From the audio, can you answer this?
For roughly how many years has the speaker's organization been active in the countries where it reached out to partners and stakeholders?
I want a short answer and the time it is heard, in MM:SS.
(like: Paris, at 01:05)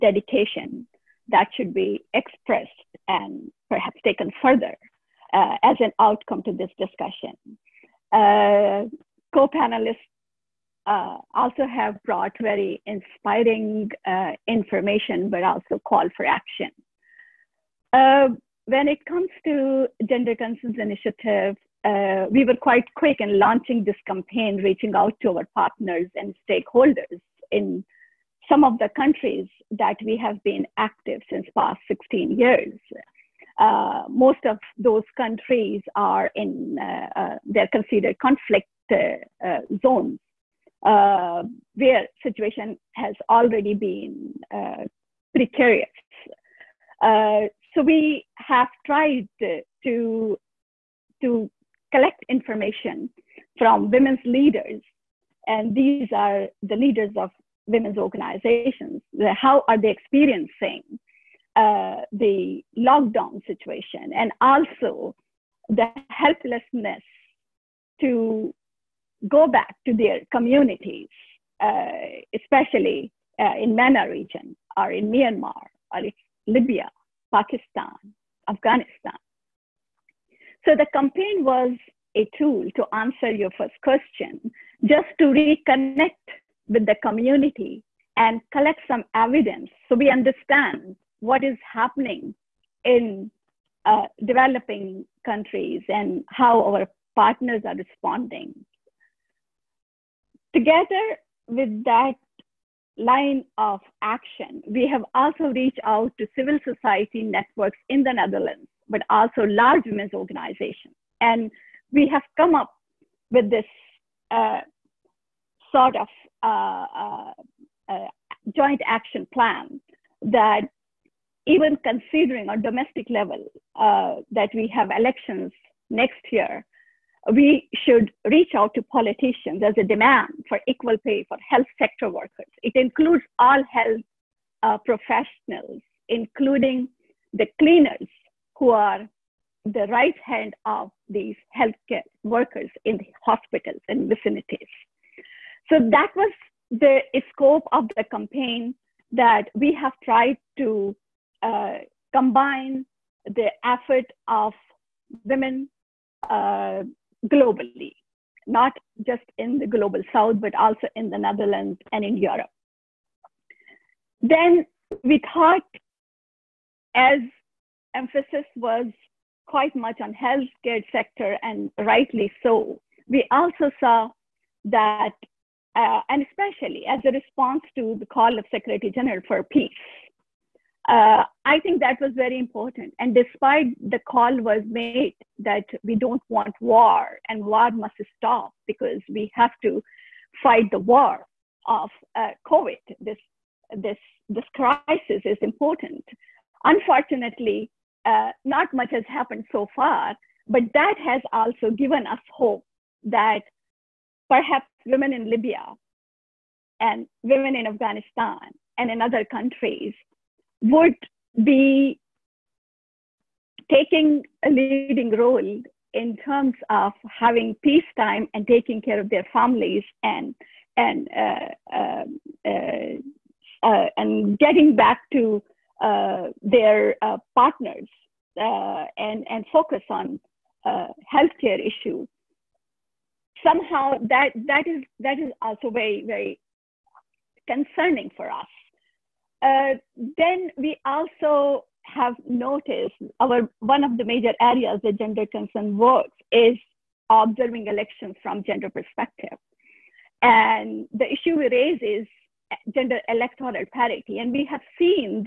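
16 years, at 00:31.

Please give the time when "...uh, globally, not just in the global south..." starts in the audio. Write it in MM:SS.
02:36.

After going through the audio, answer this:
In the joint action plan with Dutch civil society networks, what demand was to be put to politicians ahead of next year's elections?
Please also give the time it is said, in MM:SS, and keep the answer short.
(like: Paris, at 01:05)
Equal pay, at 02:10.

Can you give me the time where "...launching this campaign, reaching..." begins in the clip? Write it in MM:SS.
00:23.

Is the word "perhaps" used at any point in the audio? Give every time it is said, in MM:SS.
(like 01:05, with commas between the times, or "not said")
00:03, 03:24.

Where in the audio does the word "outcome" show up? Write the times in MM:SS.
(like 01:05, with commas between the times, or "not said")
00:05.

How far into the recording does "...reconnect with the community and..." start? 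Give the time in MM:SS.
01:25.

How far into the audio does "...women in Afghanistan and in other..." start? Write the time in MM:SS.
03:27.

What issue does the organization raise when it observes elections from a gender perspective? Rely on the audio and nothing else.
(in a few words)
Gender electoral parity.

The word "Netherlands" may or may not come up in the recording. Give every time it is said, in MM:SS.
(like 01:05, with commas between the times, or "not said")
01:48, 02:41.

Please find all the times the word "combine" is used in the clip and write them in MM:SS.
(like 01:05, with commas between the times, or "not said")
02:32.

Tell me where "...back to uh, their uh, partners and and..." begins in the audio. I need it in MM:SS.
03:44.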